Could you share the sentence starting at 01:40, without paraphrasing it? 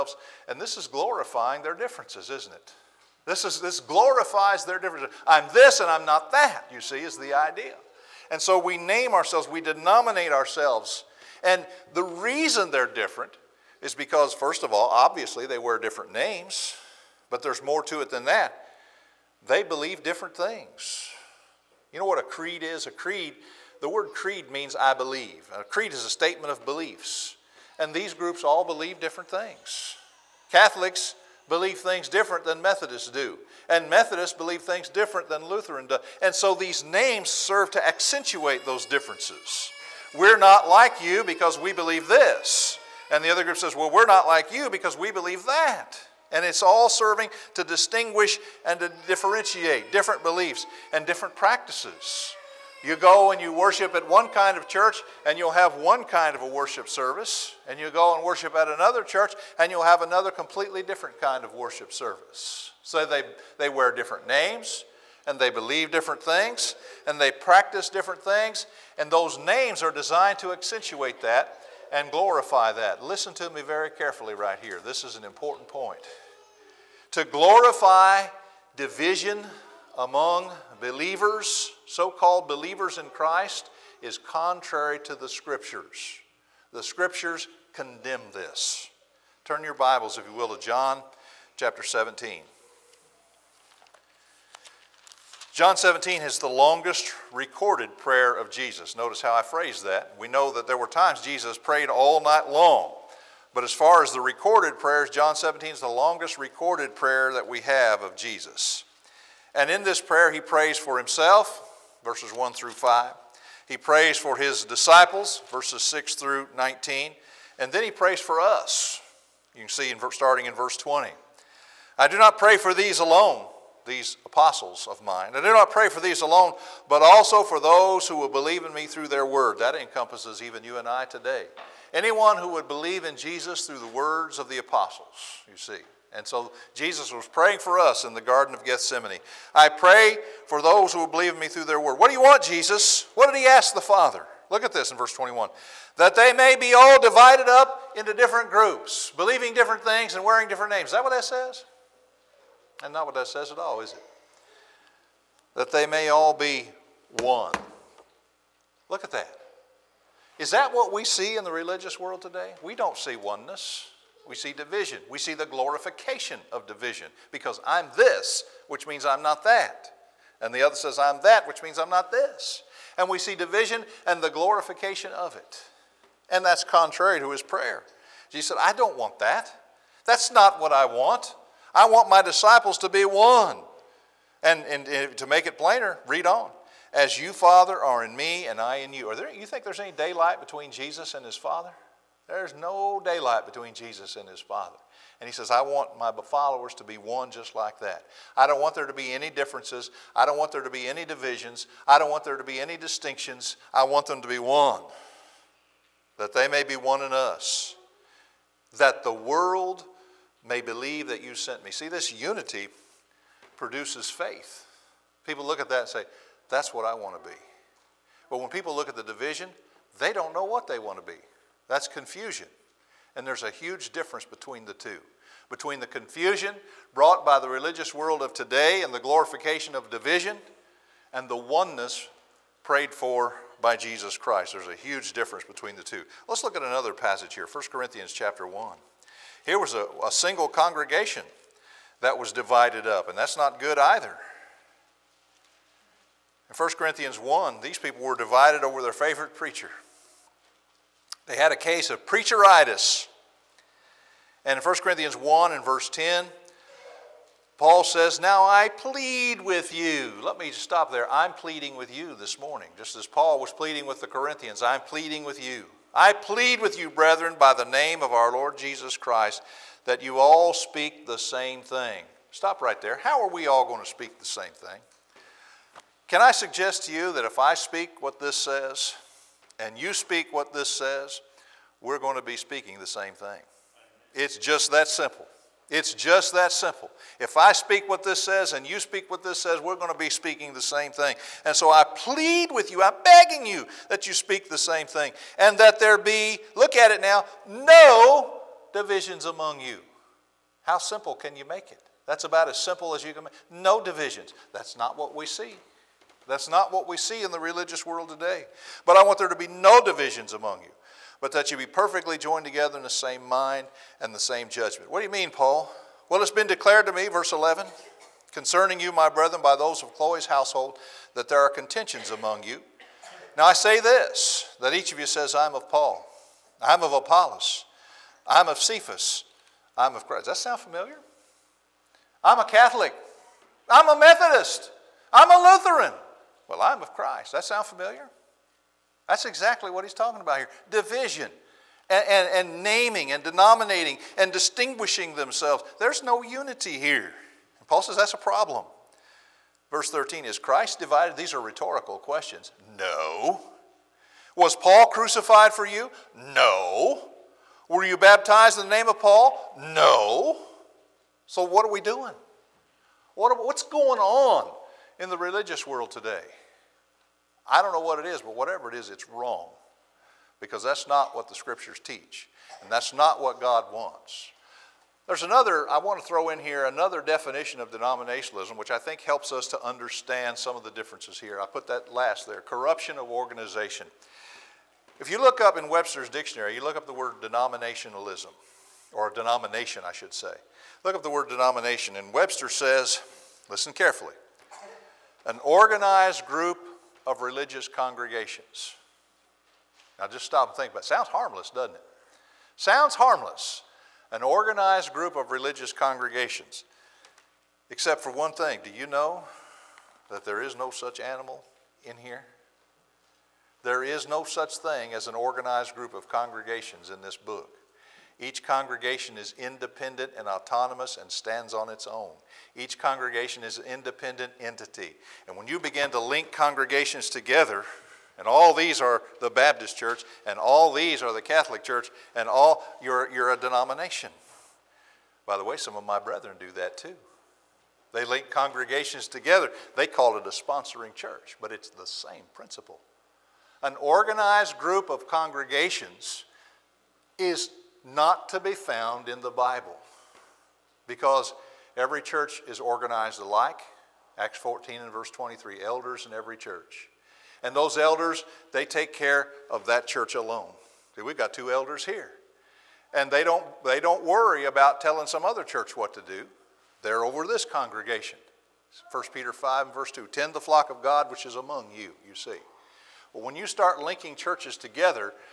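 We know that there were times Jesus prayed all night long.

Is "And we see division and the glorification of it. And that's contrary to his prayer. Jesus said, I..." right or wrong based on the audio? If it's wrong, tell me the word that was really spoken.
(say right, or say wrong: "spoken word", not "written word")
right.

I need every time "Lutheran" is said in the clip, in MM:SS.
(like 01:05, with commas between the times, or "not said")
00:35, 05:35.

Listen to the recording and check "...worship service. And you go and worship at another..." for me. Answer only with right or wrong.
right.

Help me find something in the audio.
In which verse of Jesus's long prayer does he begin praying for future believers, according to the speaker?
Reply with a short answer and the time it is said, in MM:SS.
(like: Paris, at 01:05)
verse 20, at 02:00.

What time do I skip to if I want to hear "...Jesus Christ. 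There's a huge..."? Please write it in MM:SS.
03:53.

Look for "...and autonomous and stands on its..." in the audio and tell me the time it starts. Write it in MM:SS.
07:00.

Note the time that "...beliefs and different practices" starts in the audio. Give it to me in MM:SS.
00:50.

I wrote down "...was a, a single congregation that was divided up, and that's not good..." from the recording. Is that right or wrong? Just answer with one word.
right.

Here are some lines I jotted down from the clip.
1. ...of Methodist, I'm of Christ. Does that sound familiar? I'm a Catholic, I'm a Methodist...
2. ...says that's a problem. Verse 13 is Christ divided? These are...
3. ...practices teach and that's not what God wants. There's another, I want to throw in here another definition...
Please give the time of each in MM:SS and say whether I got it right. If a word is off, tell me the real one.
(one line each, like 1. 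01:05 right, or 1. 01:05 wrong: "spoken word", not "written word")
1. 05:28 wrong: "Cephas", not "Methodist"
2. 05:47 right
3. 06:11 wrong: "scriptures", not "practices".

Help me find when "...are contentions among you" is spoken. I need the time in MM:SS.
05:21.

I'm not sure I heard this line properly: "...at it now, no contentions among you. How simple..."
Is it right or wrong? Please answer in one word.
wrong.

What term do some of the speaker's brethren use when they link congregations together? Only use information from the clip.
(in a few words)
sponsoring church.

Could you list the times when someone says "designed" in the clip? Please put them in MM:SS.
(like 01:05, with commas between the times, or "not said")
01:09.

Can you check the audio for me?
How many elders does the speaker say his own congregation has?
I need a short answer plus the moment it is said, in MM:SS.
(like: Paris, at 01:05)
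2, at 07:41.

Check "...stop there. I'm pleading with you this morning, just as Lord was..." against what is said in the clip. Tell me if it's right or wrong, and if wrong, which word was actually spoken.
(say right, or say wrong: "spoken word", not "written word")
wrong: "Paul", not "Lord".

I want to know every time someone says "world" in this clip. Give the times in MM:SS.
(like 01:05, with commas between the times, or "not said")
02:41, 03:29, 03:47, 05:07, 06:05.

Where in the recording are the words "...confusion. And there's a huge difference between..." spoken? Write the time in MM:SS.
03:41.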